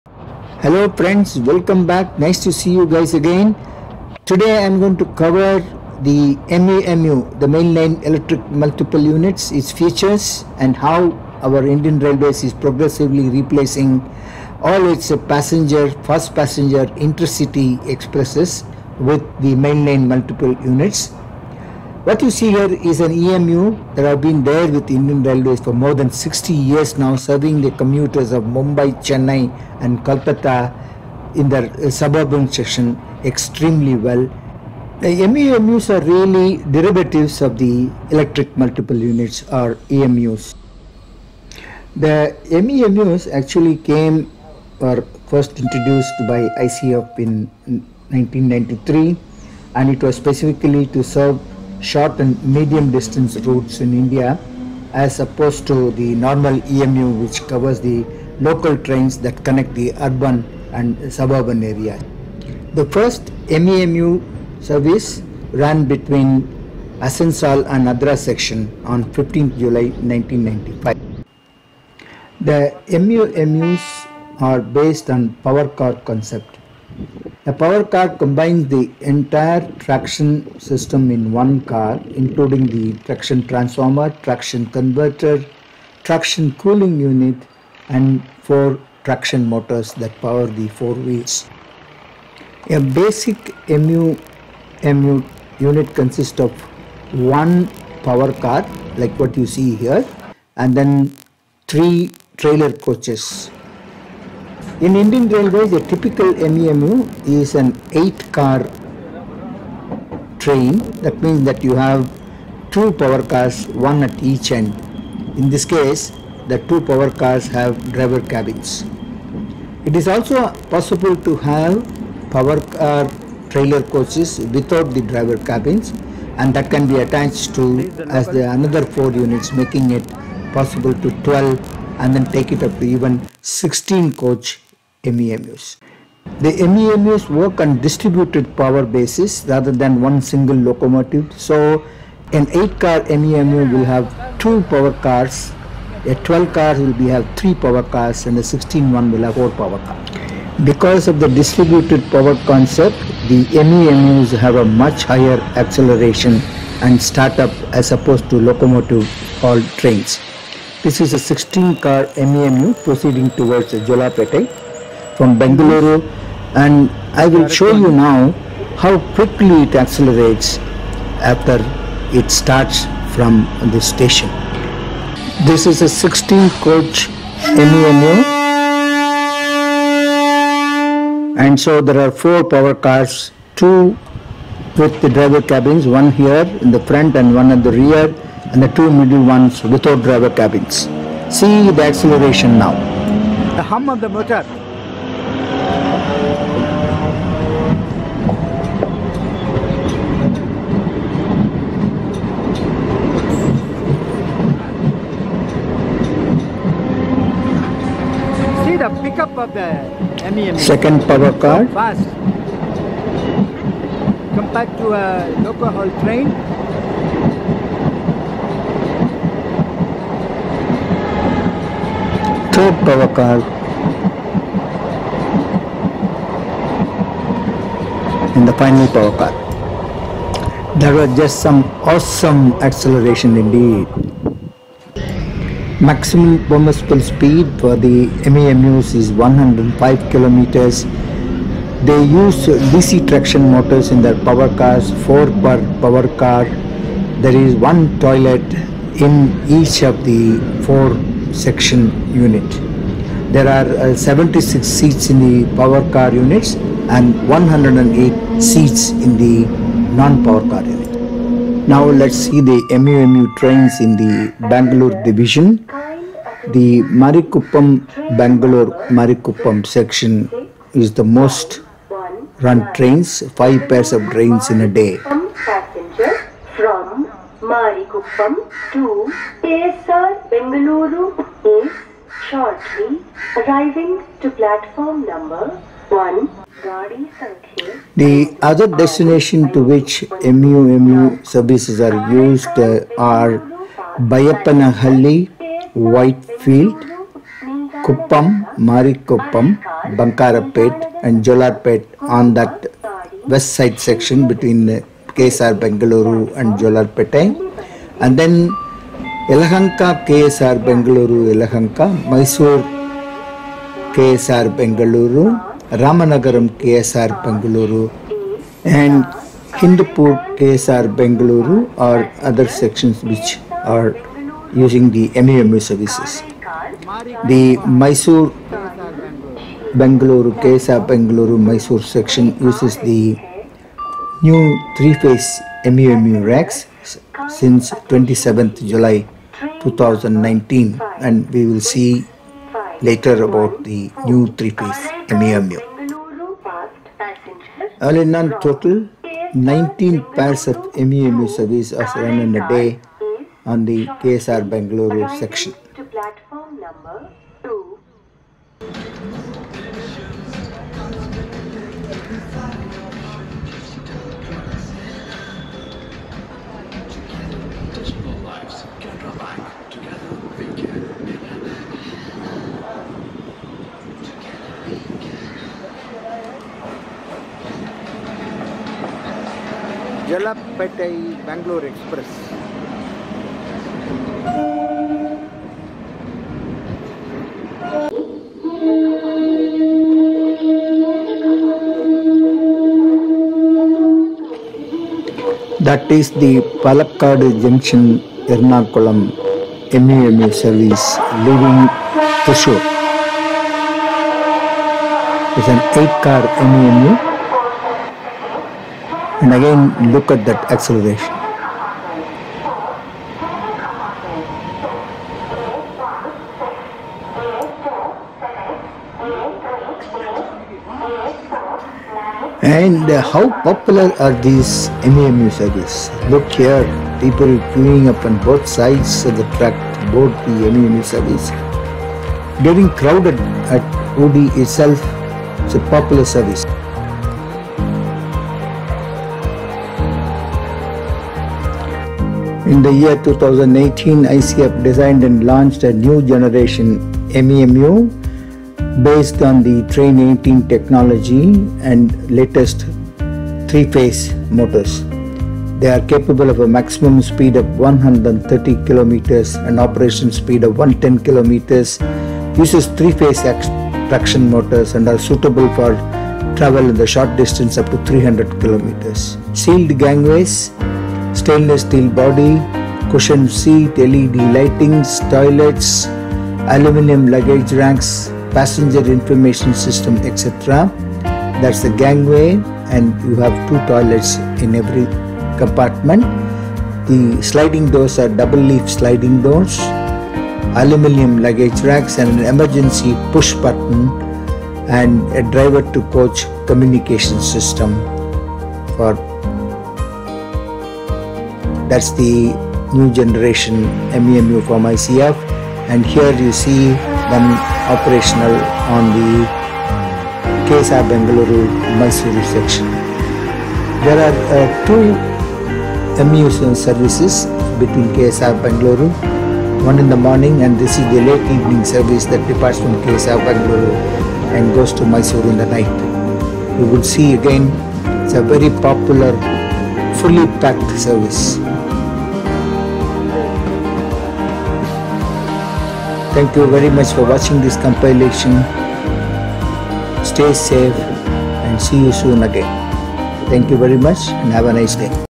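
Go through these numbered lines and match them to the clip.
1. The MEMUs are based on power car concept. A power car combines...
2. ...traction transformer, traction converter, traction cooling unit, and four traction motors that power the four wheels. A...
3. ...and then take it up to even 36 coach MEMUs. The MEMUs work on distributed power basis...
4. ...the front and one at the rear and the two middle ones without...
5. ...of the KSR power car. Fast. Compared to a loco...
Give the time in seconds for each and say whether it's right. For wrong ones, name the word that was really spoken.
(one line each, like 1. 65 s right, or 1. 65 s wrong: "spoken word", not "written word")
1. 72 s right
2. 83 s right
3. 131 s wrong: "16", not "36"
4. 186 s right
5. 209 s wrong: "Second", not "KSR".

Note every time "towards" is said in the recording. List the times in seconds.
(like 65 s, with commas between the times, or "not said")
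163 s.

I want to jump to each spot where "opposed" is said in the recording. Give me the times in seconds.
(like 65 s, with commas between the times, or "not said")
55 s, 157 s.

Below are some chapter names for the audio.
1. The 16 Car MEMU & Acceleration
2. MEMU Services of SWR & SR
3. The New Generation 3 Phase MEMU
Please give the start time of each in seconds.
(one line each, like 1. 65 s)
1. 144 s
2. 262 s
3. 441 s.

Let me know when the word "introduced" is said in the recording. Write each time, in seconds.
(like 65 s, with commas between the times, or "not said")
45 s.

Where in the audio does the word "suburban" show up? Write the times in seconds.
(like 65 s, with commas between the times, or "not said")
31 s, 61 s.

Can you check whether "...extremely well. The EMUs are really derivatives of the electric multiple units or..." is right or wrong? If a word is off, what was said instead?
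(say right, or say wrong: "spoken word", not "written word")
right.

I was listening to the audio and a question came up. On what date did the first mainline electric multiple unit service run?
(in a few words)
15 July 1995.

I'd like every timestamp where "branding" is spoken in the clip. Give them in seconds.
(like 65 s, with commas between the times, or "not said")
not said.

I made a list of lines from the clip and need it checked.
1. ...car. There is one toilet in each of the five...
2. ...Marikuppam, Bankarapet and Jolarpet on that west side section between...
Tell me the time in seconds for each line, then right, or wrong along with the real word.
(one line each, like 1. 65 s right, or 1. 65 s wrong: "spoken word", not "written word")
1. 246 s wrong: "four", not "five"
2. 298 s right.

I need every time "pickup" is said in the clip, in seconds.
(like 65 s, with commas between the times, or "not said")
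209 s.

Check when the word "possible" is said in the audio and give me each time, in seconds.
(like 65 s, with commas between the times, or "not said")
120 s, 130 s.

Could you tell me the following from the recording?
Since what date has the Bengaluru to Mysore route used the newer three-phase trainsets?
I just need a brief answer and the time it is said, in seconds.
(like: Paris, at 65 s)
27 July 2019, at 337 s.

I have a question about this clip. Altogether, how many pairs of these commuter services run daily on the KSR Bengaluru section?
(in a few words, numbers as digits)
19.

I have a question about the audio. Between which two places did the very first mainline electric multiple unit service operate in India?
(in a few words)
Asansol and Adra.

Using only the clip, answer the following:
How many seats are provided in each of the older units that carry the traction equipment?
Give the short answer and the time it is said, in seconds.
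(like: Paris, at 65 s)
76, at 253 s.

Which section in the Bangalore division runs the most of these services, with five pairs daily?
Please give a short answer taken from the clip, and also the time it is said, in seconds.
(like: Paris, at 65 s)
Marikuppam Bangalore, at 266 s.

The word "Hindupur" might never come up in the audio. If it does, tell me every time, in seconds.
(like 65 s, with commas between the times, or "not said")
319 s.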